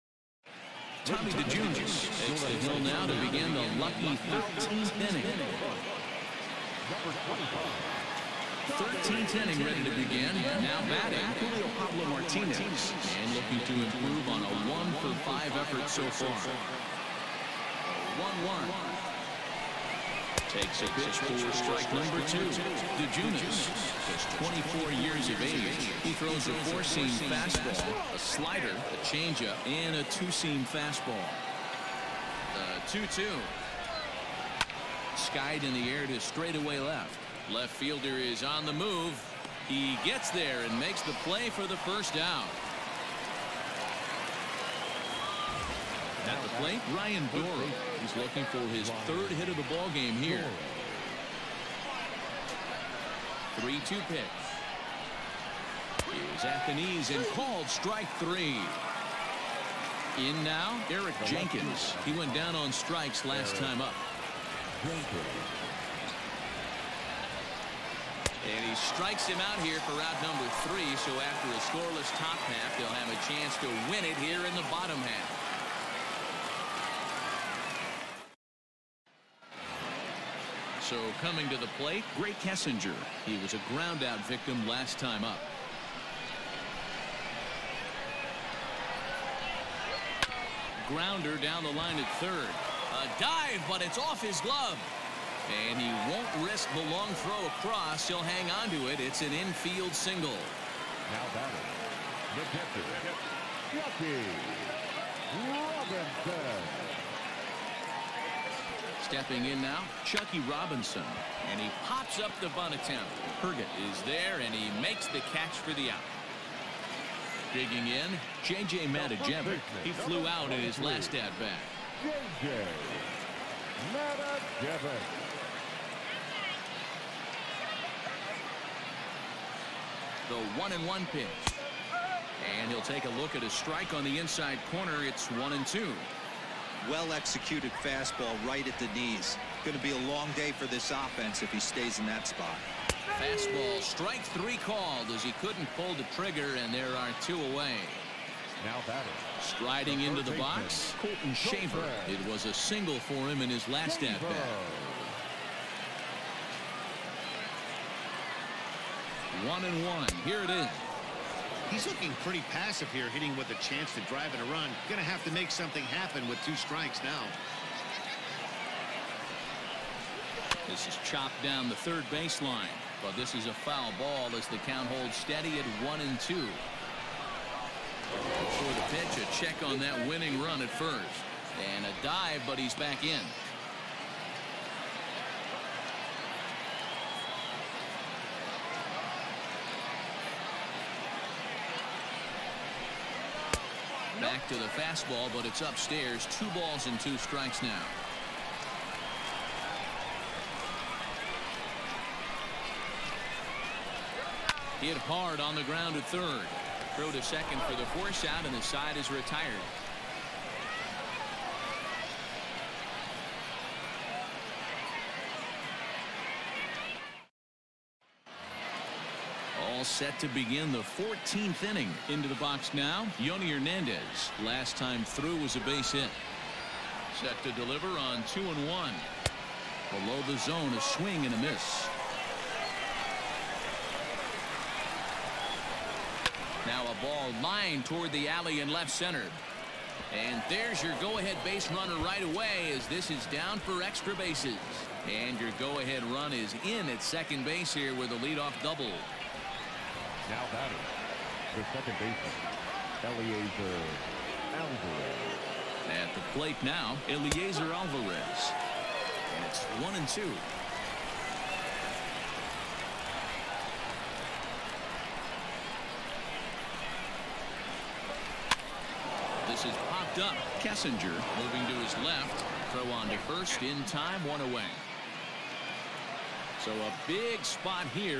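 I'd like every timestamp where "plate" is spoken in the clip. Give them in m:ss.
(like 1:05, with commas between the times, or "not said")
0:46, 1:21, 4:16.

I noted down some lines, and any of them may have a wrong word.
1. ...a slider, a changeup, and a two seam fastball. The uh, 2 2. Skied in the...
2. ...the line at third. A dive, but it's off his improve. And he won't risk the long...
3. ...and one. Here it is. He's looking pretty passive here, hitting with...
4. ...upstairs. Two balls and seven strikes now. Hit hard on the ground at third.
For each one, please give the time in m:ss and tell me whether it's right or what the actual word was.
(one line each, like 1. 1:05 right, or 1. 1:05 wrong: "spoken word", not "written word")
1. 0:28 right
2. 1:31 wrong: "glove", not "improve"
3. 2:39 right
4. 3:15 wrong: "two", not "seven".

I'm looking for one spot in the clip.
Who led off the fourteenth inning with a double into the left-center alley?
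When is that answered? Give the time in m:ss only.
3:43.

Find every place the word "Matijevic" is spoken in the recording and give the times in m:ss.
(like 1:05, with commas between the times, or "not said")
1:58, 2:03.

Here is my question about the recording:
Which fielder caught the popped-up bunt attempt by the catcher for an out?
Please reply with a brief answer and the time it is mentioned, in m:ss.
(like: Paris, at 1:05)
Herget, at 1:53.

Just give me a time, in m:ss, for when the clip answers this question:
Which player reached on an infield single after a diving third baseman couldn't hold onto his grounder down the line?
1:22.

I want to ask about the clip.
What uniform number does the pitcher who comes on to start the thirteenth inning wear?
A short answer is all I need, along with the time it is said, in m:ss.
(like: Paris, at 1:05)
25, at 0:06.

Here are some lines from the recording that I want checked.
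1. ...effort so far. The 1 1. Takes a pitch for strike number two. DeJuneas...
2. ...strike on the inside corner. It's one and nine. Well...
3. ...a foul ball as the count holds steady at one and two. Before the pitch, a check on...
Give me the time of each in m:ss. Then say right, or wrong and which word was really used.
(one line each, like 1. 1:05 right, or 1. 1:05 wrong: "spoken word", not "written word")
1. 0:15 right
2. 2:13 wrong: "two", not "nine"
3. 2:53 right.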